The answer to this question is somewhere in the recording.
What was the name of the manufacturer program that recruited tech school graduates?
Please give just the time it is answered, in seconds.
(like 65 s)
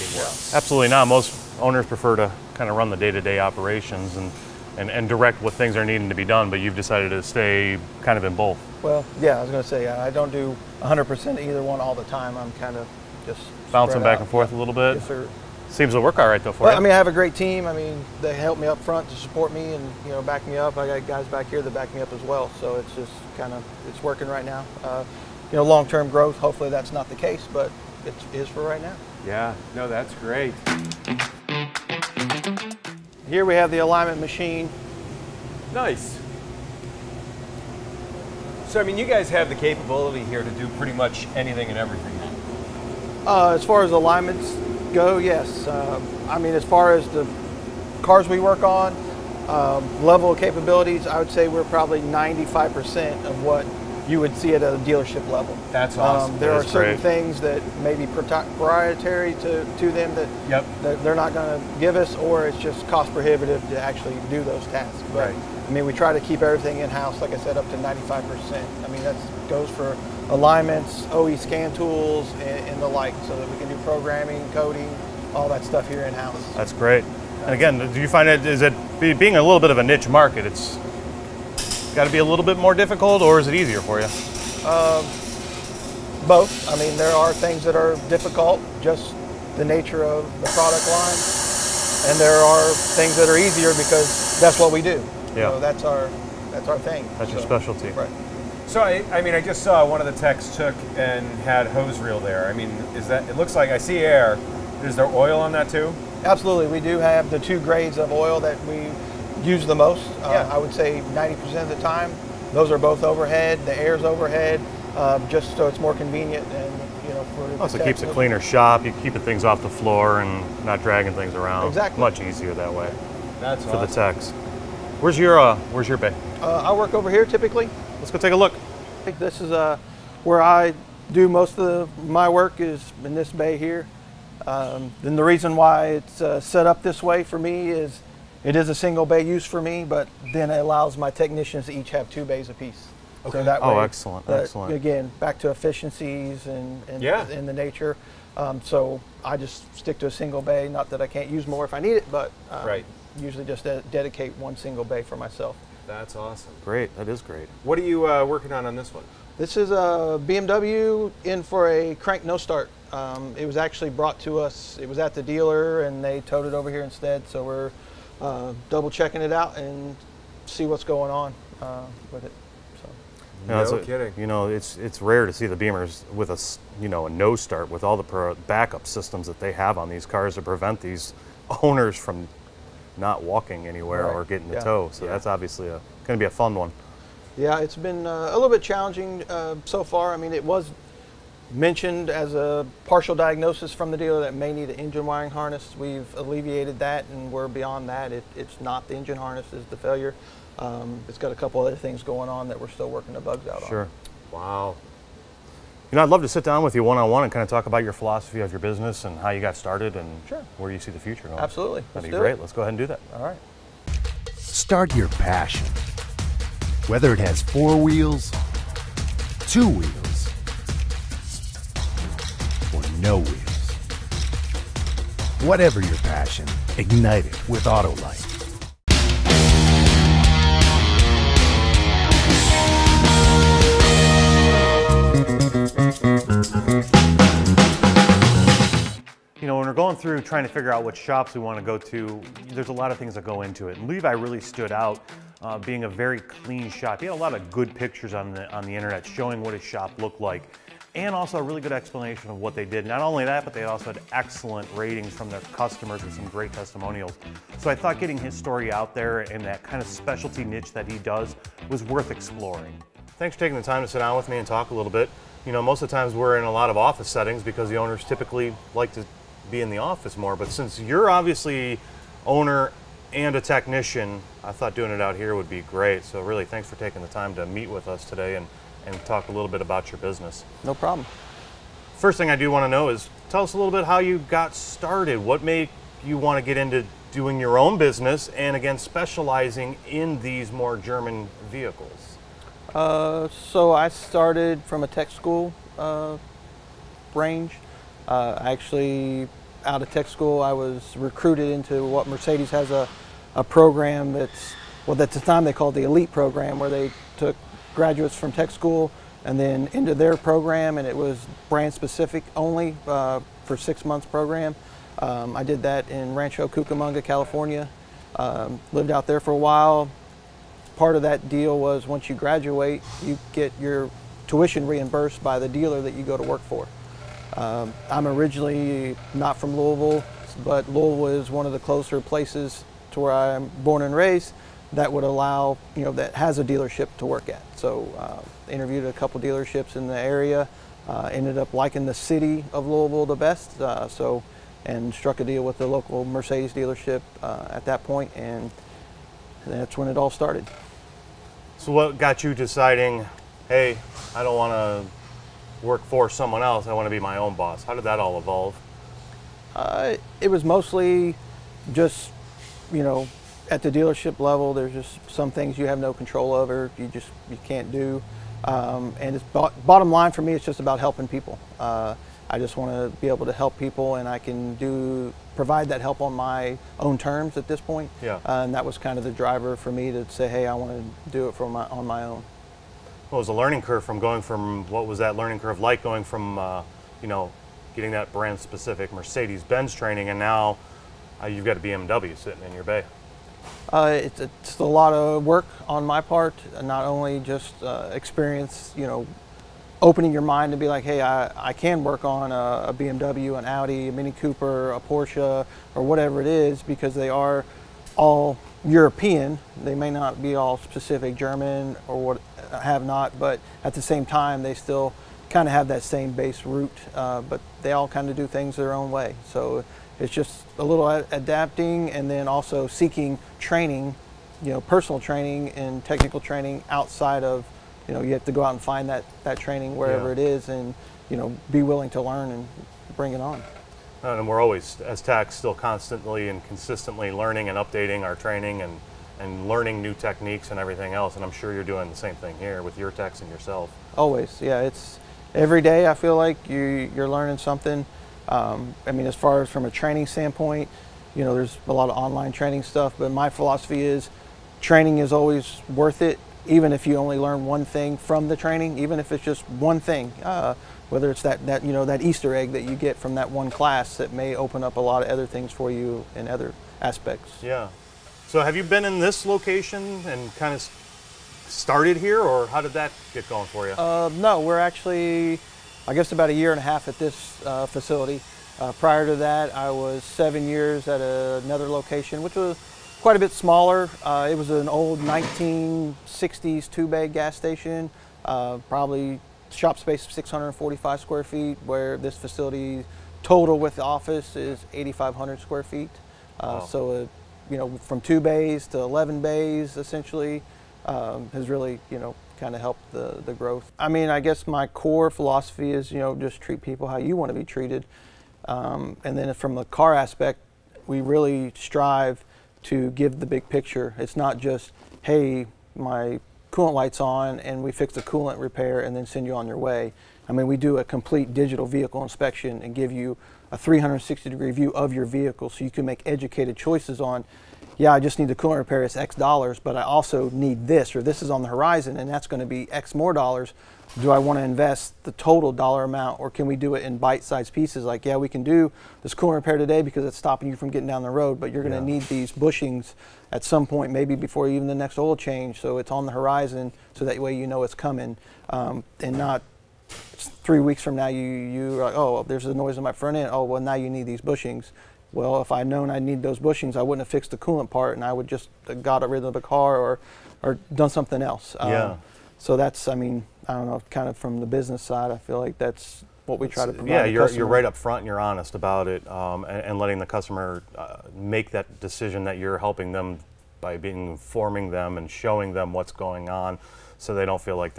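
305 s.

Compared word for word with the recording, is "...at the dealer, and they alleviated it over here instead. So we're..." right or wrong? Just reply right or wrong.
wrong.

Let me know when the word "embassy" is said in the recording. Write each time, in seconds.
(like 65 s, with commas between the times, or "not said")
not said.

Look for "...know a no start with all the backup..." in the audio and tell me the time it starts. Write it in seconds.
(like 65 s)
176 s.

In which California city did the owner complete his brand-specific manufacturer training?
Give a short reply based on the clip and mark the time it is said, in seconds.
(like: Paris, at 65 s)
Rancho Cucamonga, at 316 s.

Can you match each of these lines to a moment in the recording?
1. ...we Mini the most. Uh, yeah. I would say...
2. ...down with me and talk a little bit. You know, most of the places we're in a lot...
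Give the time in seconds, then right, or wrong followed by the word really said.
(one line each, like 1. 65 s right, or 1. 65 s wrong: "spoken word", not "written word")
1. 108 s wrong: "Use", not "Mini"
2. 263 s wrong: "times", not "places".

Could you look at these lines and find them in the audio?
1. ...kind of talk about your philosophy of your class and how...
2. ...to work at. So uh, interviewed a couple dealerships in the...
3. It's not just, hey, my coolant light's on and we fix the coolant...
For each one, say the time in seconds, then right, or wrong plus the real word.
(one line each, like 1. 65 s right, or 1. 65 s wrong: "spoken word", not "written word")
1. 207 s wrong: "business", not "class"
2. 336 s right
3. 513 s right.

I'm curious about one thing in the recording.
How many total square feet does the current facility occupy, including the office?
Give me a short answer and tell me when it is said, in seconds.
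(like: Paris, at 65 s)
8,500, at 494 s.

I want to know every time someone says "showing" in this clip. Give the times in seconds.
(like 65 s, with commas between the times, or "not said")
249 s, 575 s.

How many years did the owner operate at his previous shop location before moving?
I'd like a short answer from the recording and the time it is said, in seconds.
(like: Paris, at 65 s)
7, at 480 s.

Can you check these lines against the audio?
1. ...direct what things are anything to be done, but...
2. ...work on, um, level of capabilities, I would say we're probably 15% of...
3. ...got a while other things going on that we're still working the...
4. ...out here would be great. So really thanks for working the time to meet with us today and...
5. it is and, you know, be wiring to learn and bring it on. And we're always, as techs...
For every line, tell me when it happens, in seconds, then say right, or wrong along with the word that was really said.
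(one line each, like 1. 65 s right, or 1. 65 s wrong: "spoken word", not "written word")
1. 5 s wrong: "needing", not "anything"
2. 48 s wrong: "95", not "15"
3. 201 s wrong: "couple", not "while"
4. 275 s wrong: "taking", not "working"
5. 430 s wrong: "willing", not "wiring".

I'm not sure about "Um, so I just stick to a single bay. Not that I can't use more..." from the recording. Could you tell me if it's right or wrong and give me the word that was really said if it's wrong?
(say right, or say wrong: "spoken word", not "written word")
right.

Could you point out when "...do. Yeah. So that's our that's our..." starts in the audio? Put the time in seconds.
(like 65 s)
94 s.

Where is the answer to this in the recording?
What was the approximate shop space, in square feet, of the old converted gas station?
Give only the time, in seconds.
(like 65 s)
490 s.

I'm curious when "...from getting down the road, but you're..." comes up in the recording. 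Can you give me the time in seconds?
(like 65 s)
540 s.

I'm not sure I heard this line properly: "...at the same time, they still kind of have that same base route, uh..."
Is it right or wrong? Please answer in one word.
right.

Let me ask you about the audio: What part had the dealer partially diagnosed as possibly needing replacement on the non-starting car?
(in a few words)
engine wiring harness.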